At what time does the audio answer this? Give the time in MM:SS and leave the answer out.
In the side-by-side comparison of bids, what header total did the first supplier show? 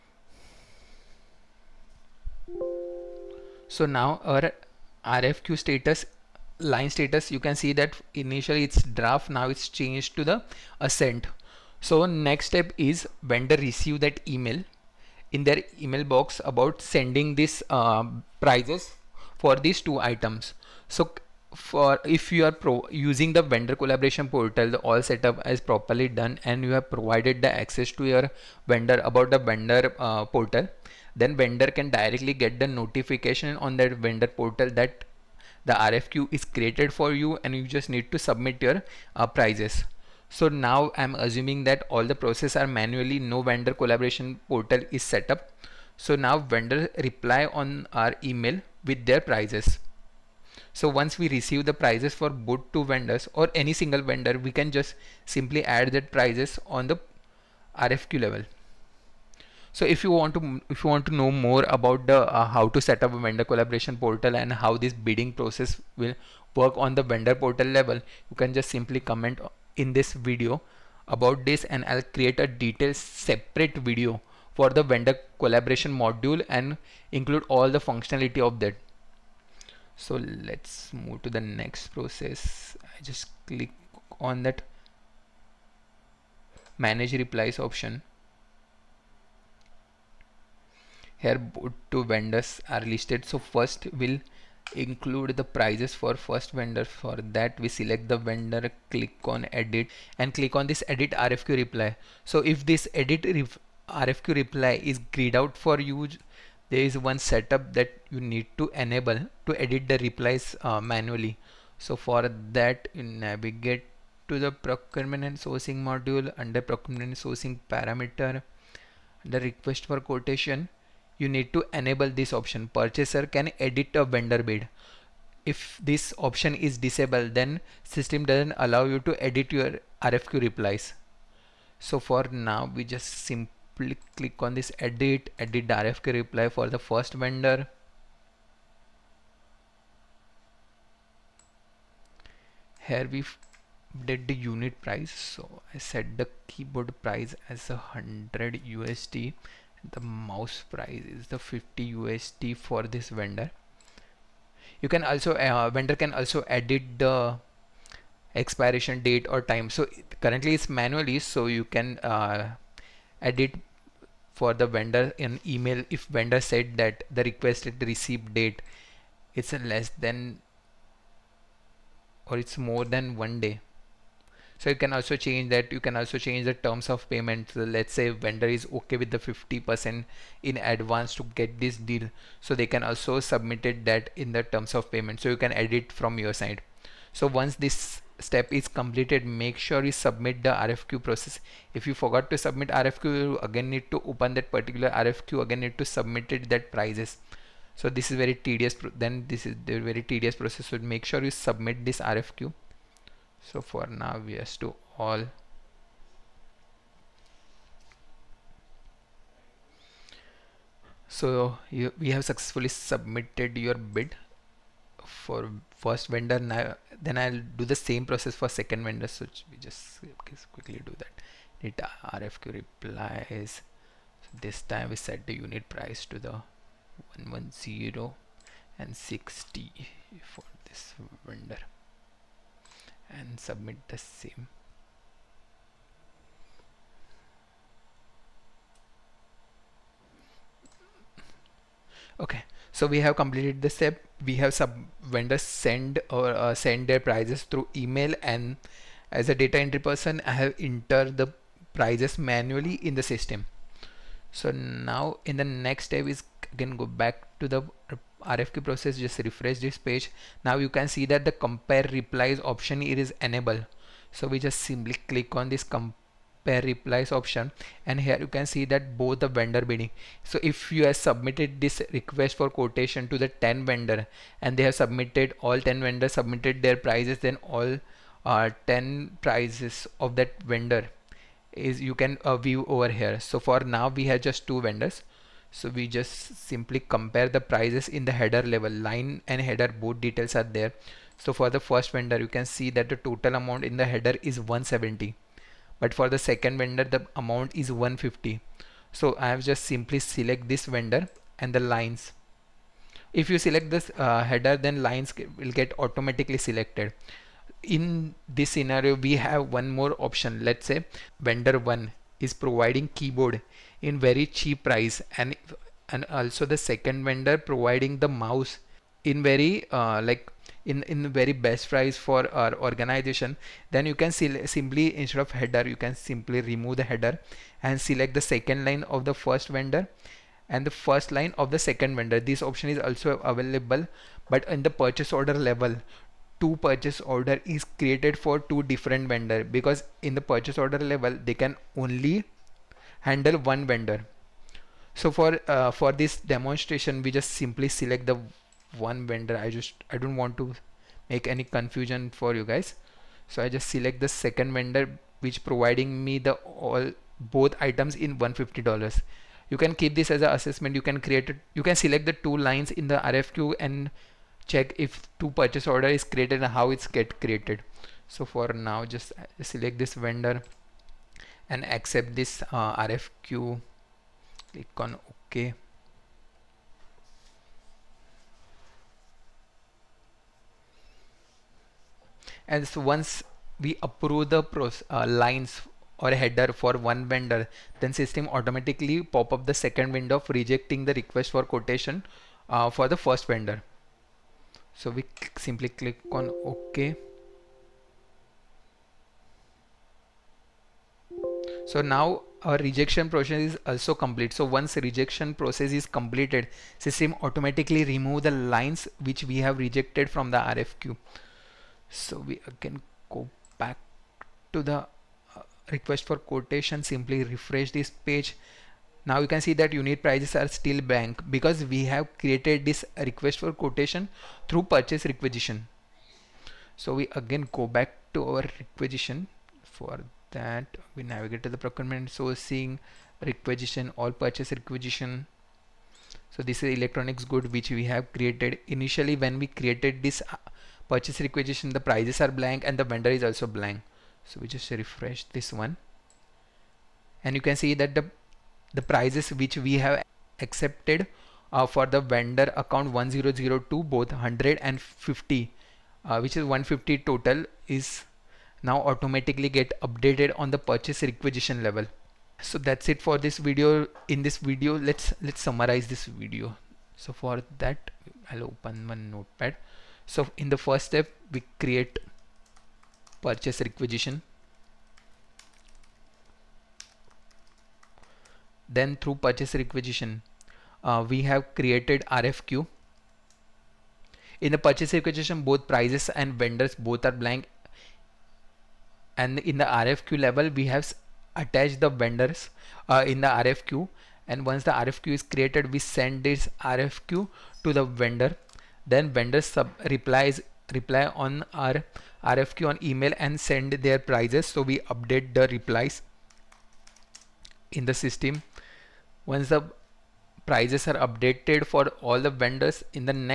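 04:54.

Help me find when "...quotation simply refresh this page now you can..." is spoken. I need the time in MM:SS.
06:56.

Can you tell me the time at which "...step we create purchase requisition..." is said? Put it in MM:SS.
07:50.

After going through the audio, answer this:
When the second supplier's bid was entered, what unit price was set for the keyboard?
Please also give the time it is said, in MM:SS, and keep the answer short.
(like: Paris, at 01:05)
110, at 03:46.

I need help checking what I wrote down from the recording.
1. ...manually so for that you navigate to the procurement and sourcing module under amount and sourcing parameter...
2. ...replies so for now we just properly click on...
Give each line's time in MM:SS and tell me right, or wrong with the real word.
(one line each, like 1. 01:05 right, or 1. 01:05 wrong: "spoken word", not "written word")
1. 01:50 wrong: "procurement", not "amount"
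2. 02:10 wrong: "simply", not "properly".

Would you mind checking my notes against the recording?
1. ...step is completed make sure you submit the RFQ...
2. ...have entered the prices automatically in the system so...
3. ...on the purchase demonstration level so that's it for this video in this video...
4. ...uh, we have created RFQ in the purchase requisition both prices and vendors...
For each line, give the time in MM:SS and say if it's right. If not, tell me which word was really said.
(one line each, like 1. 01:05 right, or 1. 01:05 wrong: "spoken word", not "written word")
1. 03:08 right
2. 04:10 wrong: "manually", not "automatically"
3. 07:40 wrong: "requisition", not "demonstration"
4. 08:00 right.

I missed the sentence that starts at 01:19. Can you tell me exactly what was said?
So let's move to the next process.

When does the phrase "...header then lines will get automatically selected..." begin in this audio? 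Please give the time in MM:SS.
05:04.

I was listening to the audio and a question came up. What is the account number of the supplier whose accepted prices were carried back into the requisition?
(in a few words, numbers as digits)
1002.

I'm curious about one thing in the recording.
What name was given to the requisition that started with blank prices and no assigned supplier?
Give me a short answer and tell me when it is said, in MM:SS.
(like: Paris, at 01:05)
Electronics good, at 07:16.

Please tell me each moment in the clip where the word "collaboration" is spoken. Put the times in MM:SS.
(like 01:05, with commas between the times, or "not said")
00:23, 00:43, 01:03, 01:15.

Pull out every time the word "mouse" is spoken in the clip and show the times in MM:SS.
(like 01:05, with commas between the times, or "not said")
02:29, 05:18.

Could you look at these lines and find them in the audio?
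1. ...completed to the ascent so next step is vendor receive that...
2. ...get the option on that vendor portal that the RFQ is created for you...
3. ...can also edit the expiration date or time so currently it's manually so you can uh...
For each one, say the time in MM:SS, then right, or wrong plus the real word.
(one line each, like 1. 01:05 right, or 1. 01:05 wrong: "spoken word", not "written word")
1. 00:09 wrong: "changed", not "completed"
2. 00:32 wrong: "notification", not "option"
3. 02:35 right.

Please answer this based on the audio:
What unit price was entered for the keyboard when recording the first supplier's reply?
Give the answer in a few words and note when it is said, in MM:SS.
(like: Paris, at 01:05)
100 USD, at 02:27.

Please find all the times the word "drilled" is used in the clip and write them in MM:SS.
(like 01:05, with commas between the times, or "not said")
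not said.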